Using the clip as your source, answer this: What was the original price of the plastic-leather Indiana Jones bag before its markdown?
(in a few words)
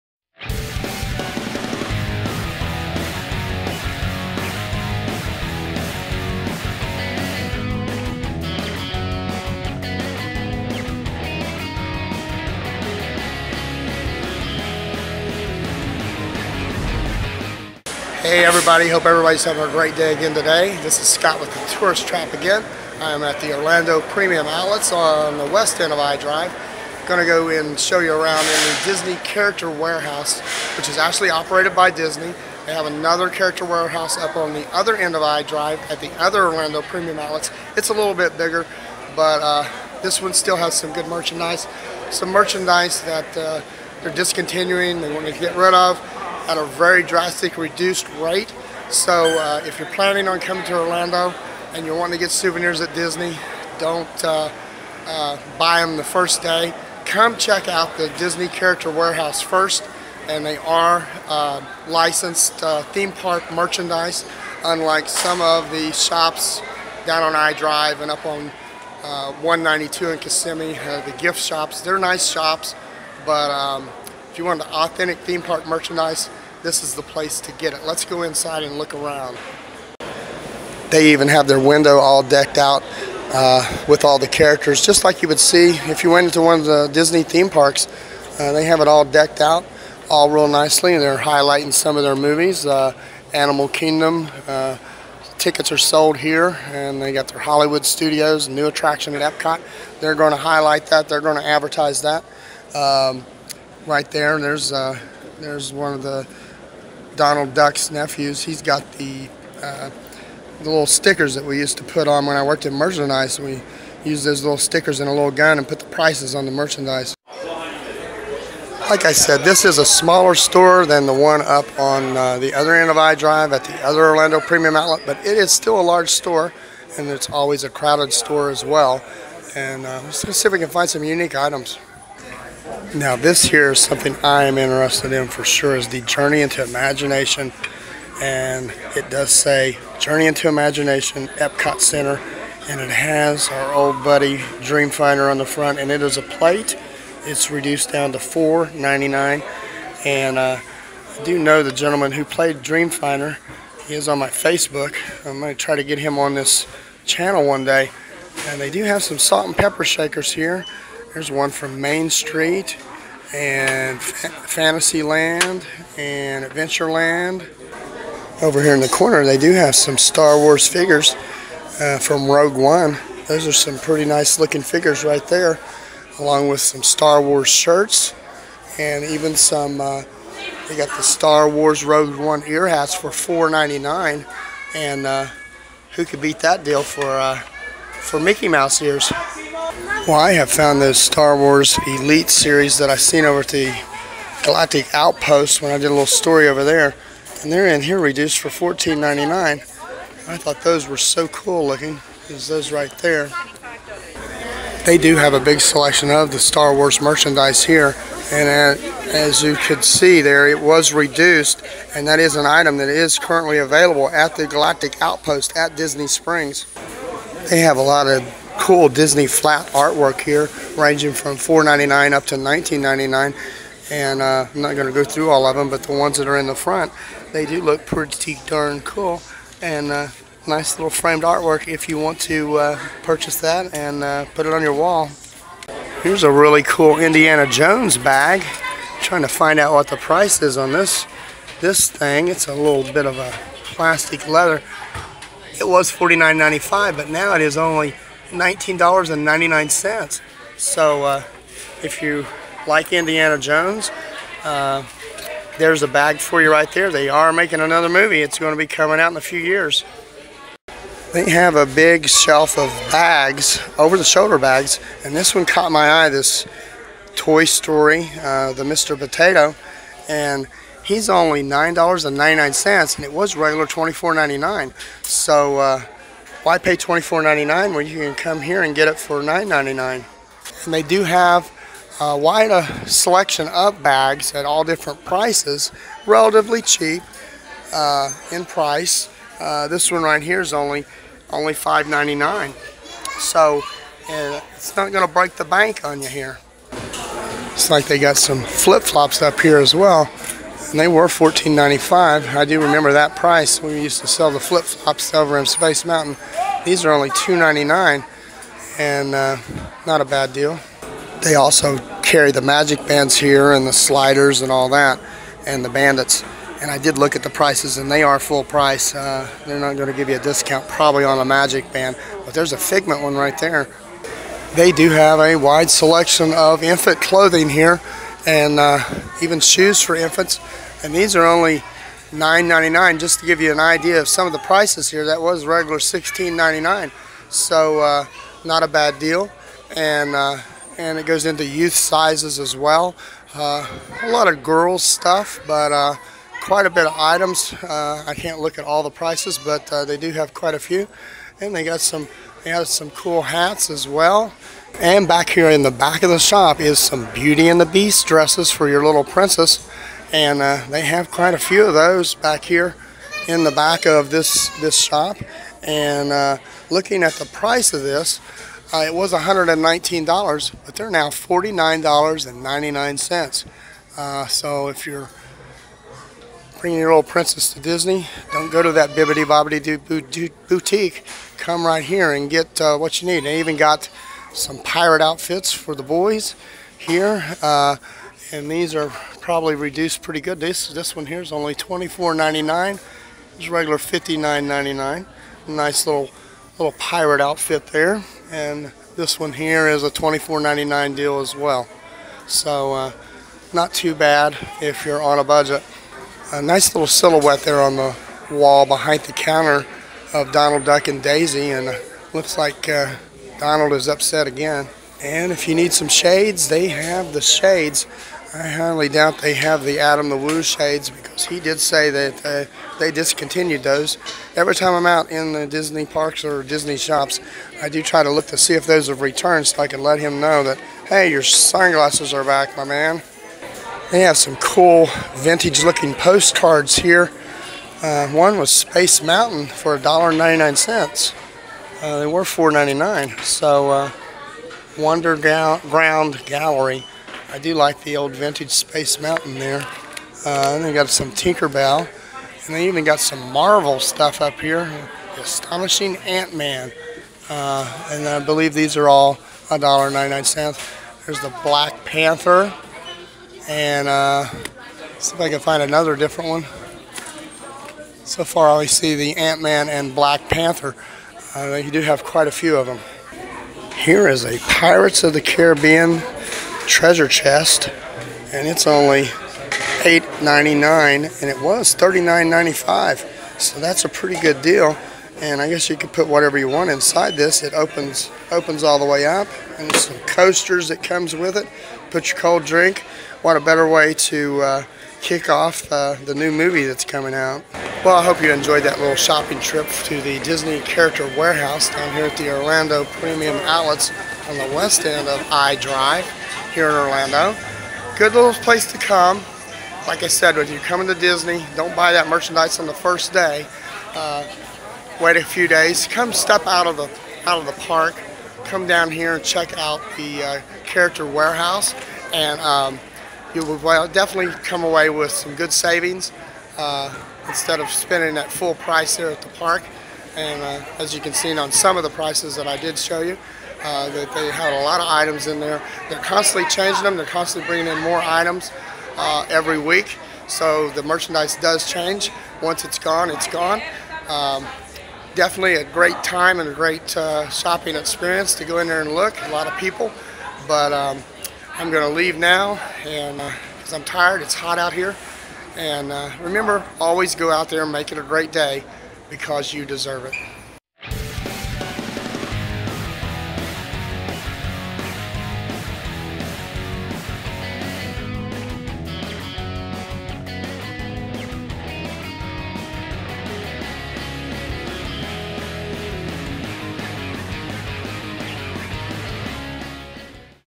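$49.95.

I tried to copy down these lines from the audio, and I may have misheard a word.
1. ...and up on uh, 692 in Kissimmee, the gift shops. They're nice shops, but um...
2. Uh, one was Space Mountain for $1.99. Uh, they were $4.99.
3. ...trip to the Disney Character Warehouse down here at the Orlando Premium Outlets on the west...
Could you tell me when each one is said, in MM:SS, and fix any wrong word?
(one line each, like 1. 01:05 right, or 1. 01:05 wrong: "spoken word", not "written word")
1. 01:08 wrong: "192", not "692"
2. 07:17 right
3. 08:19 right.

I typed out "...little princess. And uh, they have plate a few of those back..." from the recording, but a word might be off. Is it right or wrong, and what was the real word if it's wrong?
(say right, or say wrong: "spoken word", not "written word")
wrong: "quite", not "plate".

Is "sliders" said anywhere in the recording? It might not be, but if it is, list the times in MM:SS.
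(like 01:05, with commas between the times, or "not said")
05:13.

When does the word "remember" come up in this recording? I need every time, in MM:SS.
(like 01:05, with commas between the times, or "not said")
05:02, 09:16.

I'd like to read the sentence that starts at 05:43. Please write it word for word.
Uh, a lot of girls stuff, but uh, quite a bit of items.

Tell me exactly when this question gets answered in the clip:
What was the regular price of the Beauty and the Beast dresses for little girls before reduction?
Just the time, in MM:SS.
06:09.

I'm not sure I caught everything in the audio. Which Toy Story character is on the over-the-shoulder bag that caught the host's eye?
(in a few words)
Mr. Potato.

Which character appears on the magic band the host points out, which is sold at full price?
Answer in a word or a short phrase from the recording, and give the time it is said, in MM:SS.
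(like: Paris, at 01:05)
Figment, at 05:22.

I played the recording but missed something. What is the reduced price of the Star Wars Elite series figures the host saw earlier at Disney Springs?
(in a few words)
$14.99.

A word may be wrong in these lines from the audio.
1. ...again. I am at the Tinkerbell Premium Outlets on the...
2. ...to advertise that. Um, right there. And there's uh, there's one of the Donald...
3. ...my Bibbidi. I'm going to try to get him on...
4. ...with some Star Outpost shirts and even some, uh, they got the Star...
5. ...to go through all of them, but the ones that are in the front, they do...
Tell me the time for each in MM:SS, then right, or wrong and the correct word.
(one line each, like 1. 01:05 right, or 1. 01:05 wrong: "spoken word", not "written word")
1. 00:22 wrong: "Orlando", not "Tinkerbell"
2. 01:41 right
3. 02:34 wrong: "Facebook", not "Bibbidi"
4. 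02:56 wrong: "Wars", not "Outpost"
5. 03:44 right.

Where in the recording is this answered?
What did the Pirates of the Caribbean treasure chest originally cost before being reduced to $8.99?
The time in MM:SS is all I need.
08:01.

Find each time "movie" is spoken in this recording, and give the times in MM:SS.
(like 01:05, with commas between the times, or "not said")
01:32, 04:17, 08:16.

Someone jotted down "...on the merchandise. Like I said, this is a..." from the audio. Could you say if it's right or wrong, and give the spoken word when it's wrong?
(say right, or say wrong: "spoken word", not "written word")
right.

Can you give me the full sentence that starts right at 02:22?
And it has our old buddy Dreamfinder on the front.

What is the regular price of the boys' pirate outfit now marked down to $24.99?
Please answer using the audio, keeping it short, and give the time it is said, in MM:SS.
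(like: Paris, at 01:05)
$59.99, at 06:33.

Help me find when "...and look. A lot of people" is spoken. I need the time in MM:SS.
09:08.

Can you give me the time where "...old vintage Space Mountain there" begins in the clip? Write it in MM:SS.
07:27.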